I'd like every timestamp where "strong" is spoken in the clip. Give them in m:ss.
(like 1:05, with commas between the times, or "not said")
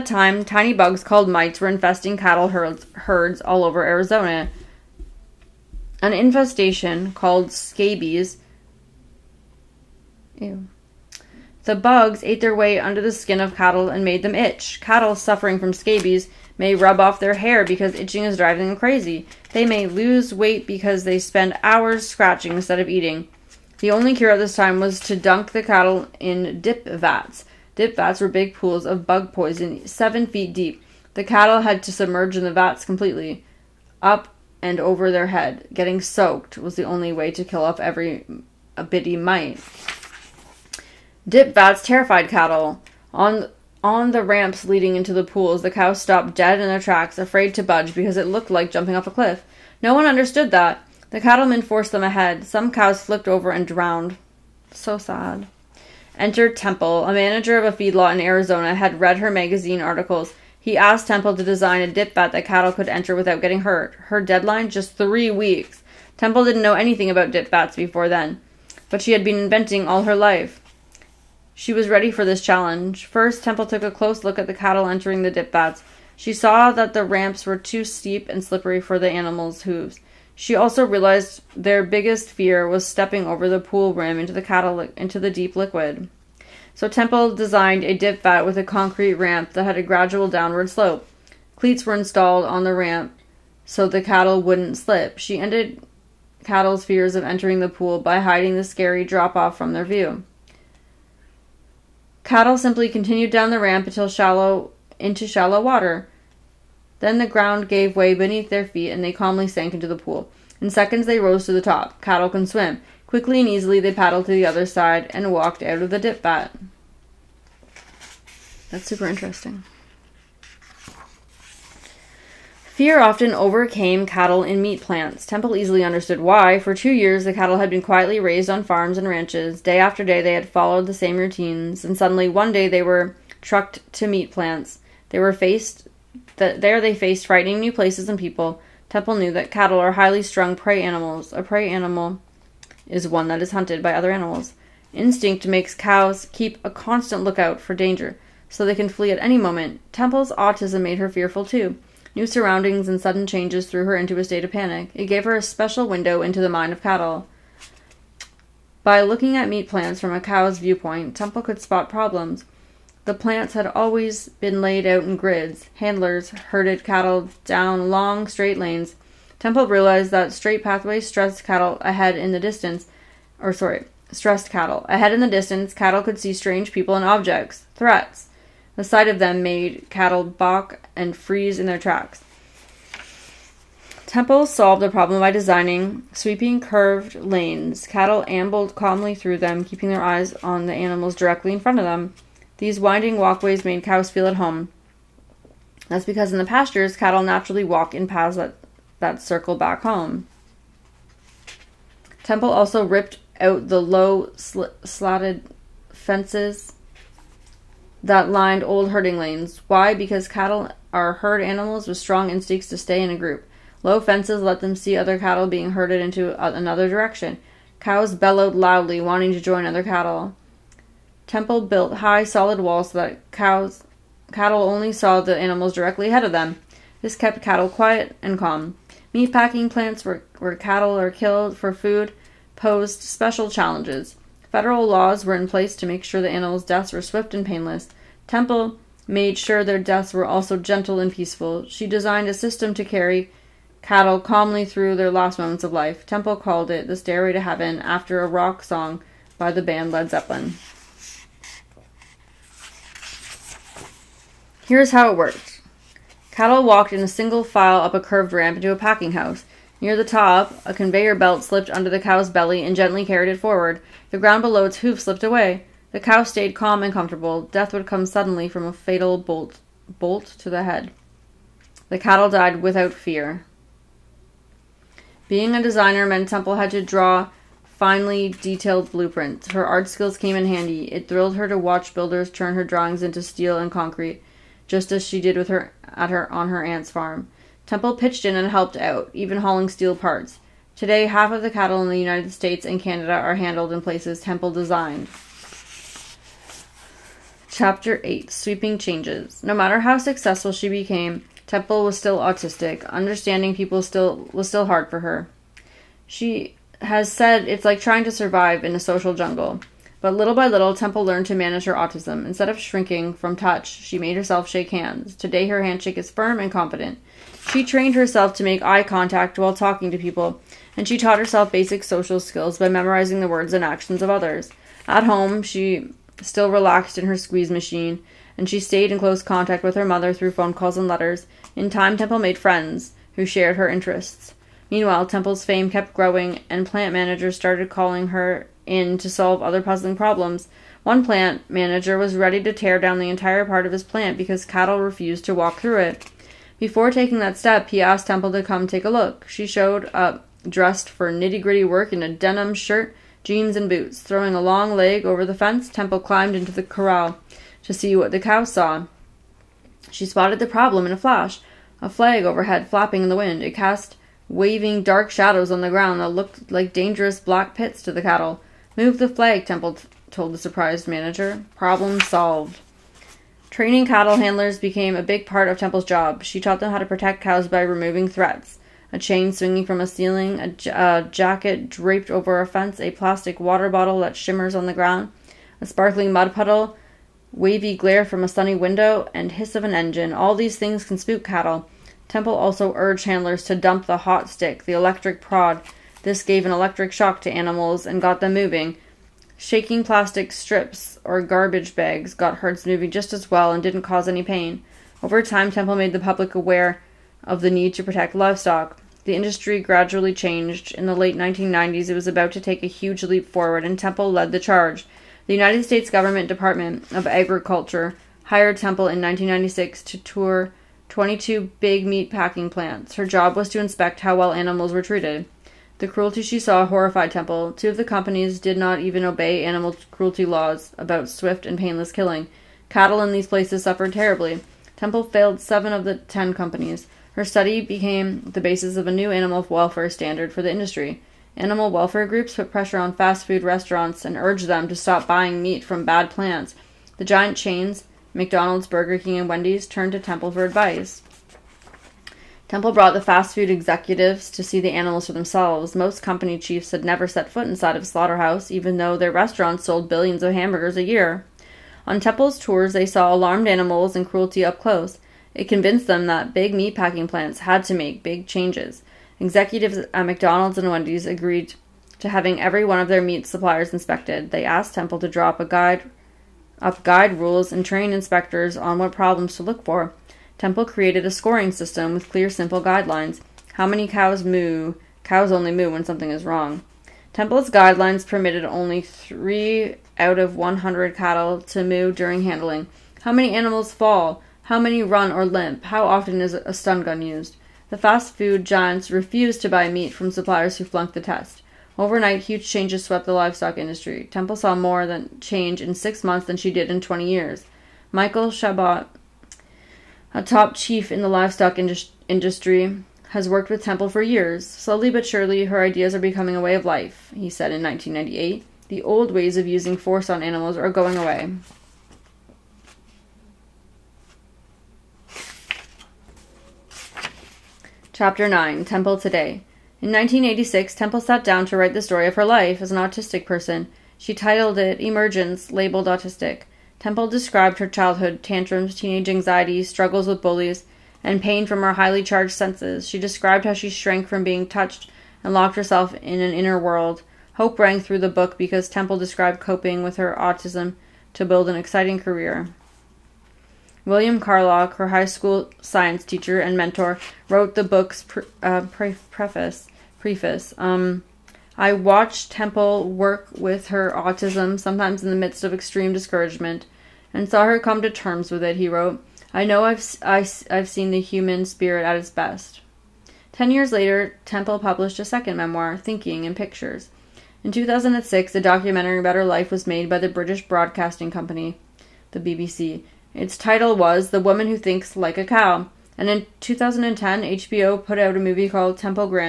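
3:31.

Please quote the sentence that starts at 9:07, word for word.
Hope rang through the book because Temple described coping with her autism to build an exciting career.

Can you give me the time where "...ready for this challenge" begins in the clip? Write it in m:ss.
1:11.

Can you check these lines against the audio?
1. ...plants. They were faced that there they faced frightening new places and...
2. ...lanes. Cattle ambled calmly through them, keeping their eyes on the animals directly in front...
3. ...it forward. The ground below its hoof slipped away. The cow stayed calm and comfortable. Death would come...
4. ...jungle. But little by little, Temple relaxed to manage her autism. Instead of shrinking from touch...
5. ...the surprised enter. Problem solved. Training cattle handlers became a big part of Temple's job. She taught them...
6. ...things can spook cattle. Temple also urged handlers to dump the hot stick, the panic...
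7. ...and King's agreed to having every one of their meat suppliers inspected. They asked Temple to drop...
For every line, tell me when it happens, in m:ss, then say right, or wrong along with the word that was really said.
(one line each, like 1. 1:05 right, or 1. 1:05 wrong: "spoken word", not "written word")
1. 2:14 right
2. 3:07 right
3. 4:23 right
4. 5:09 wrong: "learned", not "relaxed"
5. 6:10 wrong: "manager", not "enter"
6. 6:30 wrong: "electric", not "panic"
7. 7:50 wrong: "Wendy", not "King".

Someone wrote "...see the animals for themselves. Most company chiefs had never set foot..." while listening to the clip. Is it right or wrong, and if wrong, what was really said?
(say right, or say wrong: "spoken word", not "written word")
right.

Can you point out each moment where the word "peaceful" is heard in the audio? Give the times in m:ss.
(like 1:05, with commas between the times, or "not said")
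4:01.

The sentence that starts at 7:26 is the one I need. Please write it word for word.
The giant chains, McDonald's, Burger King, and Wendy's, turned to Temple for advice.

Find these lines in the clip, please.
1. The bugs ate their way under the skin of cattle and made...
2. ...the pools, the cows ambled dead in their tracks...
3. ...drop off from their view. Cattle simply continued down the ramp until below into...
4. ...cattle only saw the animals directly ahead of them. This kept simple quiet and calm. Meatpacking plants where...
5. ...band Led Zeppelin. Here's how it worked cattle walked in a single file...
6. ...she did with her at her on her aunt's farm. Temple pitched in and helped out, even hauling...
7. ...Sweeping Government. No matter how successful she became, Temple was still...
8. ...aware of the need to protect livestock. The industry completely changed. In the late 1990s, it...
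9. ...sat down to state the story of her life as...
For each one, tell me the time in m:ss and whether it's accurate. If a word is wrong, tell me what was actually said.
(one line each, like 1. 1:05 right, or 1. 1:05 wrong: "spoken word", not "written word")
1. 0:11 right
2. 0:45 wrong: "stopped", not "ambled"
3. 1:39 wrong: "shallow", not "below"
4. 3:44 wrong: "cattle", not "simple"
5. 4:09 right
6. 4:45 right
7. 4:58 wrong: "Changes", not "Government"
8. 6:46 wrong: "gradually", not "completely"
9. 8:51 wrong: "write", not "state".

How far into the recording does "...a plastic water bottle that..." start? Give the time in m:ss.
6:22.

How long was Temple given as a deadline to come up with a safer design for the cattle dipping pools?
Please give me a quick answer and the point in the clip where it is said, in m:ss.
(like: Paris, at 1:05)
three weeks, at 1:04.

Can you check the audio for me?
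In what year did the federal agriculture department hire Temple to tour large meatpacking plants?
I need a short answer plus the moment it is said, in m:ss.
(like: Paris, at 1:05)
1996, at 6:59.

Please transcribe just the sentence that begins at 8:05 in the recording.
Cows only moo when something is wrong.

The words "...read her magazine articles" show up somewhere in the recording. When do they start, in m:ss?
0:59.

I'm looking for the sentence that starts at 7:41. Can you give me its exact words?
On Temple's tours, they saw alarmed animals and cruelty up close.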